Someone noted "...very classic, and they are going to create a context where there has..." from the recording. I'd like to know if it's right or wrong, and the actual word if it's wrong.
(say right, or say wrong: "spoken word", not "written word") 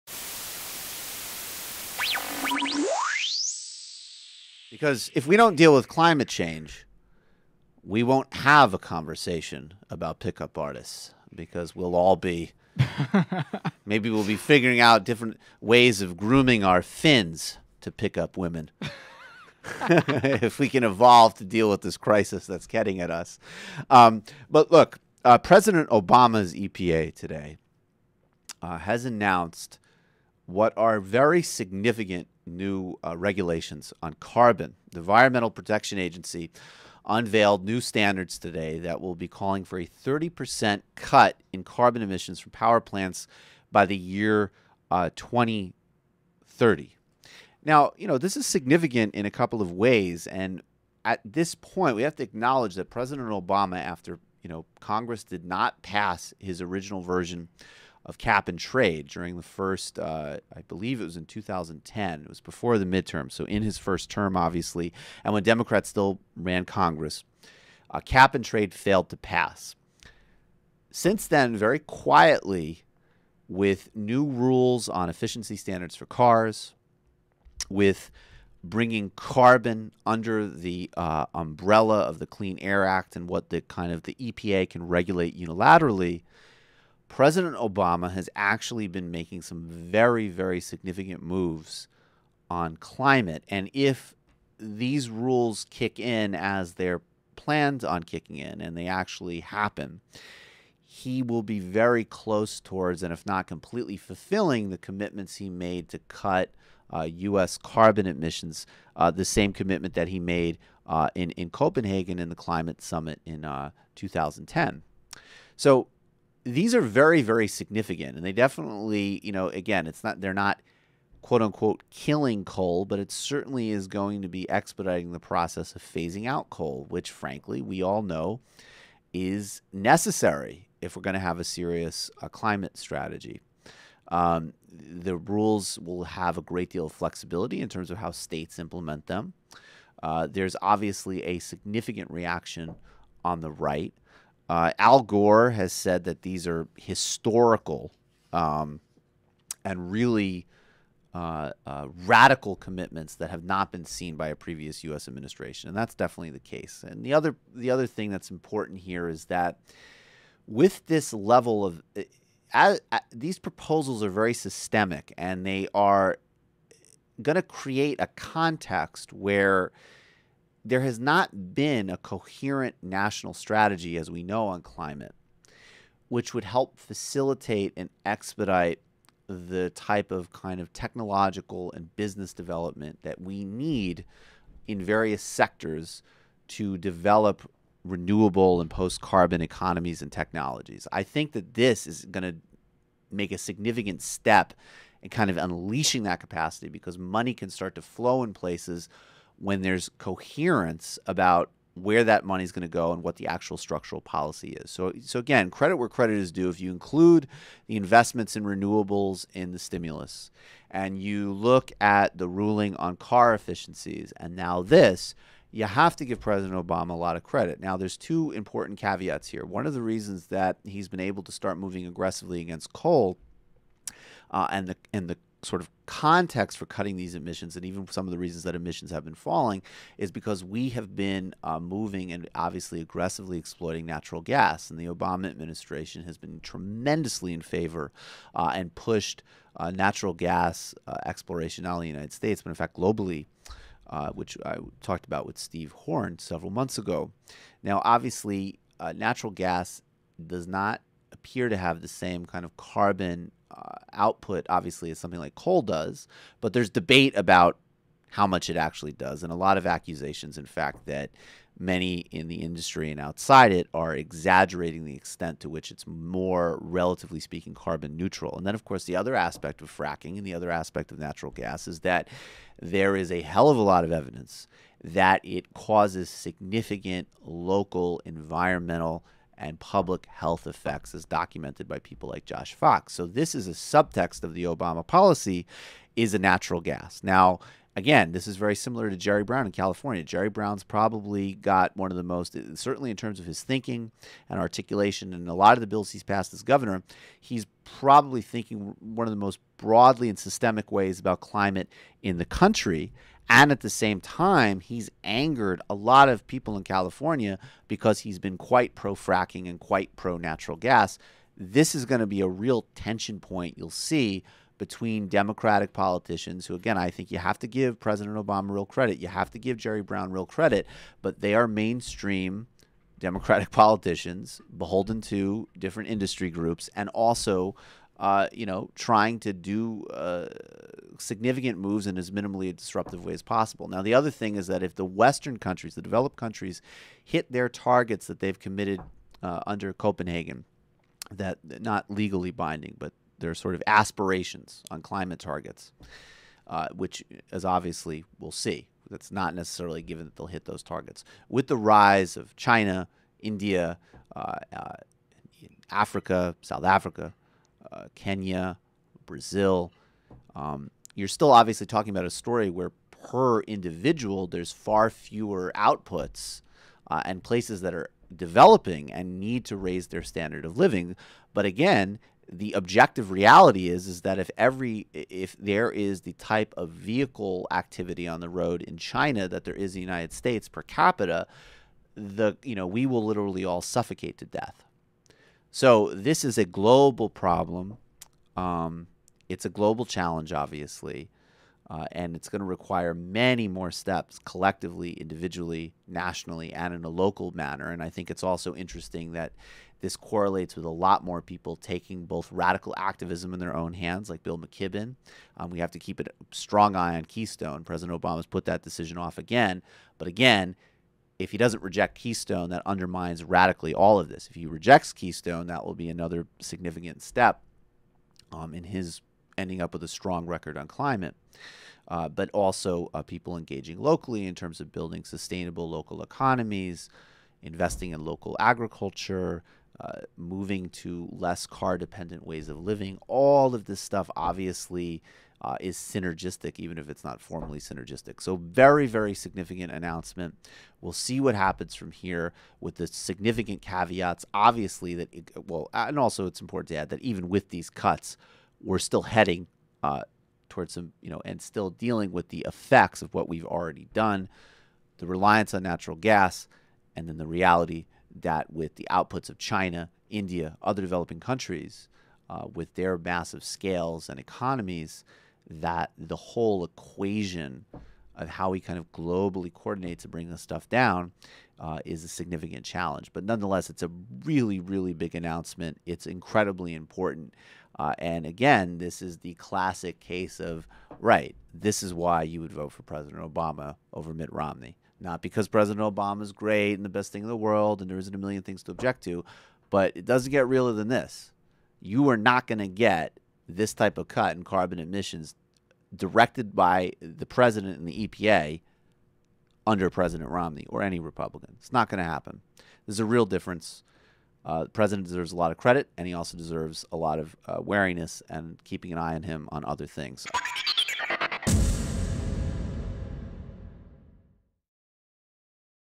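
wrong: "systemic", not "classic".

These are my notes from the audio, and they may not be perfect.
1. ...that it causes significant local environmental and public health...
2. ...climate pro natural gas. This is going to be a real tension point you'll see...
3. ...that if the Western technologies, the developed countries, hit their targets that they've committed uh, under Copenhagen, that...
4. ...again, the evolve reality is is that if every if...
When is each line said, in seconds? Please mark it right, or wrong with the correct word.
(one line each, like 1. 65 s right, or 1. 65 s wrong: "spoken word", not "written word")
1. 274 s right
2. 309 s wrong: "quite", not "climate"
3. 334 s wrong: "countries", not "technologies"
4. 371 s wrong: "objective", not "evolve".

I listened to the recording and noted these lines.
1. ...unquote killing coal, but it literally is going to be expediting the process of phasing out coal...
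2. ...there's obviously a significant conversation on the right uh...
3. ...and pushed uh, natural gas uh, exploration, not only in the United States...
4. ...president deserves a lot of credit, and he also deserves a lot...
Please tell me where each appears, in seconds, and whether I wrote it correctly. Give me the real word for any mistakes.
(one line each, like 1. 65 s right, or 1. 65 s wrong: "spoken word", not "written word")
1. 121 s wrong: "certainly", not "literally"
2. 140 s wrong: "reaction", not "conversation"
3. 238 s right
4. 504 s right.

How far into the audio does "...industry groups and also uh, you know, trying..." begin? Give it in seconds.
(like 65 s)
325 s.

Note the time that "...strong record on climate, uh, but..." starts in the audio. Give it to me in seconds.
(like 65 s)
419 s.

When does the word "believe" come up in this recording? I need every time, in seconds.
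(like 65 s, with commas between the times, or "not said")
60 s.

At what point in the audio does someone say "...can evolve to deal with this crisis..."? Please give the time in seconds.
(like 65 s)
20 s.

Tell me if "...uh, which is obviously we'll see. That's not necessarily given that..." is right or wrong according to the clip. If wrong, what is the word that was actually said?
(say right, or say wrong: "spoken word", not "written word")
right.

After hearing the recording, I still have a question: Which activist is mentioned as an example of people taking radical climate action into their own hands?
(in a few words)
Bill McKibben.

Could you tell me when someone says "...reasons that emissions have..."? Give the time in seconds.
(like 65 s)
228 s.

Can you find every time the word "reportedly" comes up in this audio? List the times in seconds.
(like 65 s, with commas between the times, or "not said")
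not said.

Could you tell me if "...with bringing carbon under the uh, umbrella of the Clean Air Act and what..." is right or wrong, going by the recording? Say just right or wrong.
right.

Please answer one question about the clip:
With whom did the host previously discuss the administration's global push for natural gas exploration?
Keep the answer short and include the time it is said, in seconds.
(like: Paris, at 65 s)
Steve Horn, at 245 s.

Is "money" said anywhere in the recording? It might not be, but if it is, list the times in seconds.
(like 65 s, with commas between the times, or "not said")
196 s, 202 s.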